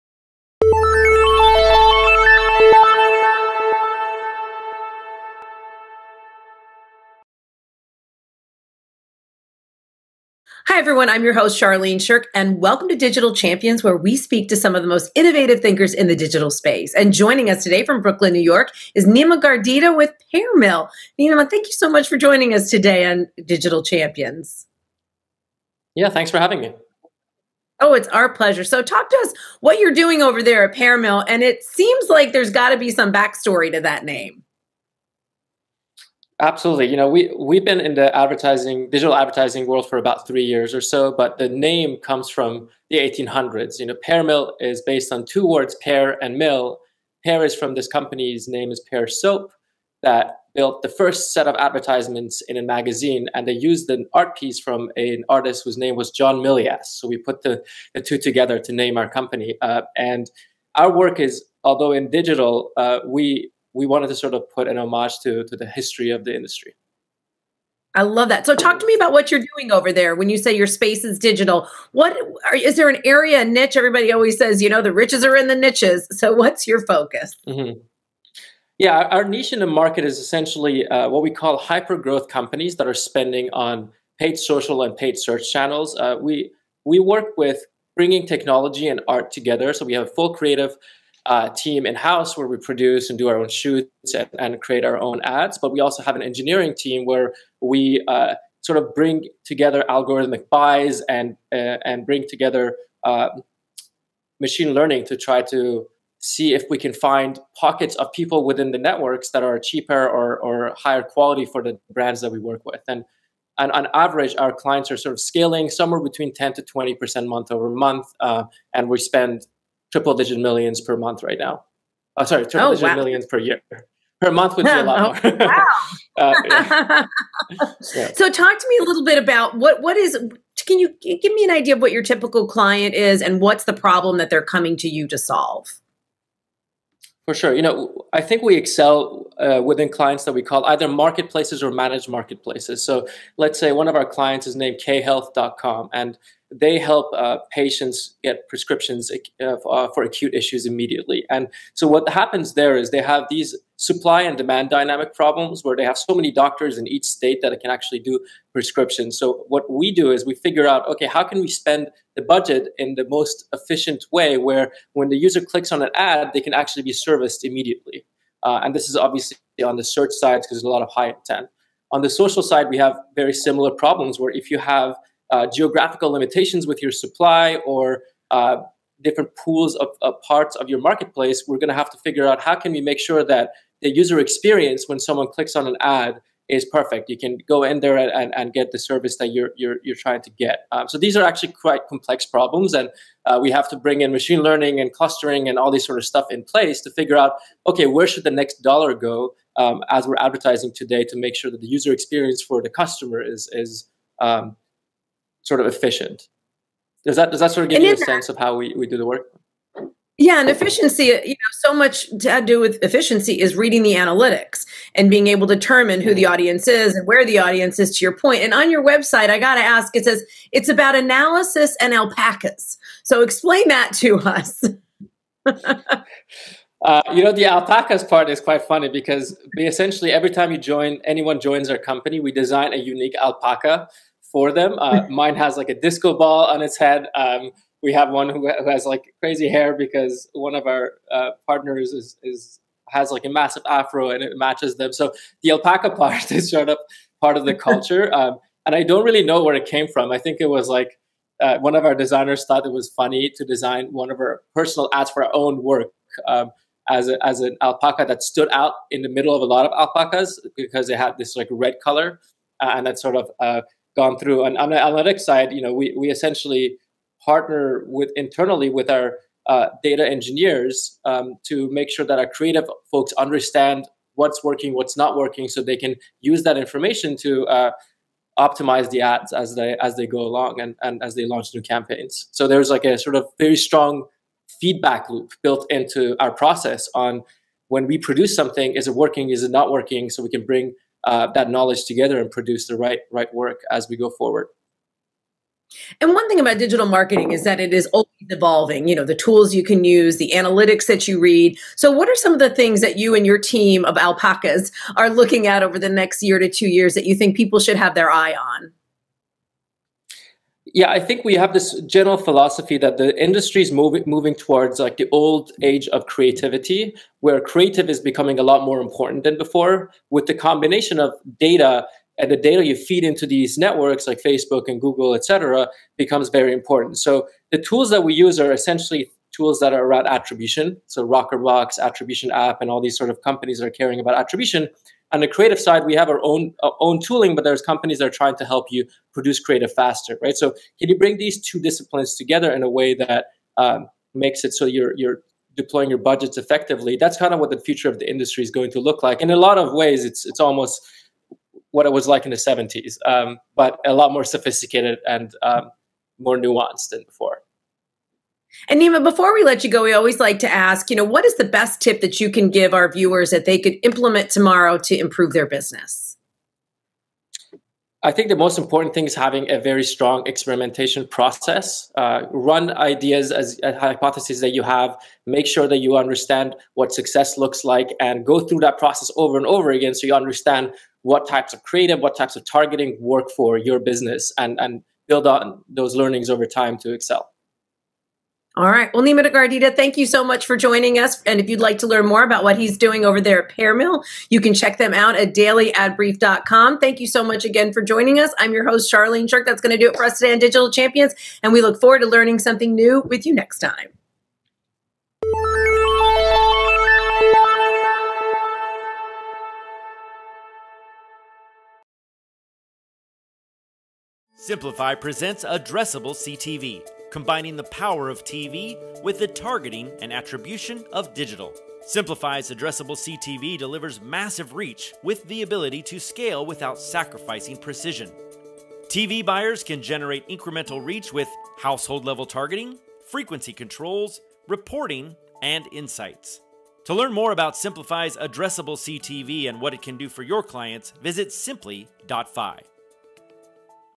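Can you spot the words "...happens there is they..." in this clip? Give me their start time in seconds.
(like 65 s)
152 s.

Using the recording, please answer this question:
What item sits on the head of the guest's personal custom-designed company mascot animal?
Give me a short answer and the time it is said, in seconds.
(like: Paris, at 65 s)
a disco ball, at 235 s.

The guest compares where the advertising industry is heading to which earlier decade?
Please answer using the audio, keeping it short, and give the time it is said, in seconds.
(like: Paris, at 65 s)
the 70s, at 352 s.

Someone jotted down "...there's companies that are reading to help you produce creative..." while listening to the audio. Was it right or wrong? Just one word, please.
wrong.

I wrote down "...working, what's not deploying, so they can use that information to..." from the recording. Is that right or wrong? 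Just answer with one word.
wrong.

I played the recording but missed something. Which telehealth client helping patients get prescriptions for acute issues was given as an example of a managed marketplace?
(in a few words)
khealth.com.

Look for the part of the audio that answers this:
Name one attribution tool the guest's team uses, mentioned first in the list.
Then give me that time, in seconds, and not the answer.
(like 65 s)
331 s.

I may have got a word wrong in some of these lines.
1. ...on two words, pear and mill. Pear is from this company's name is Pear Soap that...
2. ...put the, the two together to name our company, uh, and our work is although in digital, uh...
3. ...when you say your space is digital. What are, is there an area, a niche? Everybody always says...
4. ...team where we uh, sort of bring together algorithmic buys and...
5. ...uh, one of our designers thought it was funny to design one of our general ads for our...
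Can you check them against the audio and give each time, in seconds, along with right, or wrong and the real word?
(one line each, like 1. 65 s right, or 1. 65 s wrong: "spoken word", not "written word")
1. 45 s right
2. 57 s right
3. 70 s right
4. 96 s right
5. 251 s wrong: "personal", not "general".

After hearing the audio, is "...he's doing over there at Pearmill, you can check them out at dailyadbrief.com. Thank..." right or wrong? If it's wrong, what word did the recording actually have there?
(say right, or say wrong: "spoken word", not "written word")
right.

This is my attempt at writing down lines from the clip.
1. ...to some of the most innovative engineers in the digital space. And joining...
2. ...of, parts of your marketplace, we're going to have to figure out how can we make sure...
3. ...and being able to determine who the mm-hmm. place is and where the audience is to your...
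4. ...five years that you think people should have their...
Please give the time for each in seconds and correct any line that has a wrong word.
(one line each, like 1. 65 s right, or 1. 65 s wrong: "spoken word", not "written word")
1. 14 s wrong: "thinkers", not "engineers"
2. 180 s right
3. 214 s wrong: "audience", not "place"
4. 306 s wrong: "two", not "five".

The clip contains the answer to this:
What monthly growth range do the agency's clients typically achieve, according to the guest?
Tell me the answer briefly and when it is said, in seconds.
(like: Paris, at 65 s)
10 to 20%, at 116 s.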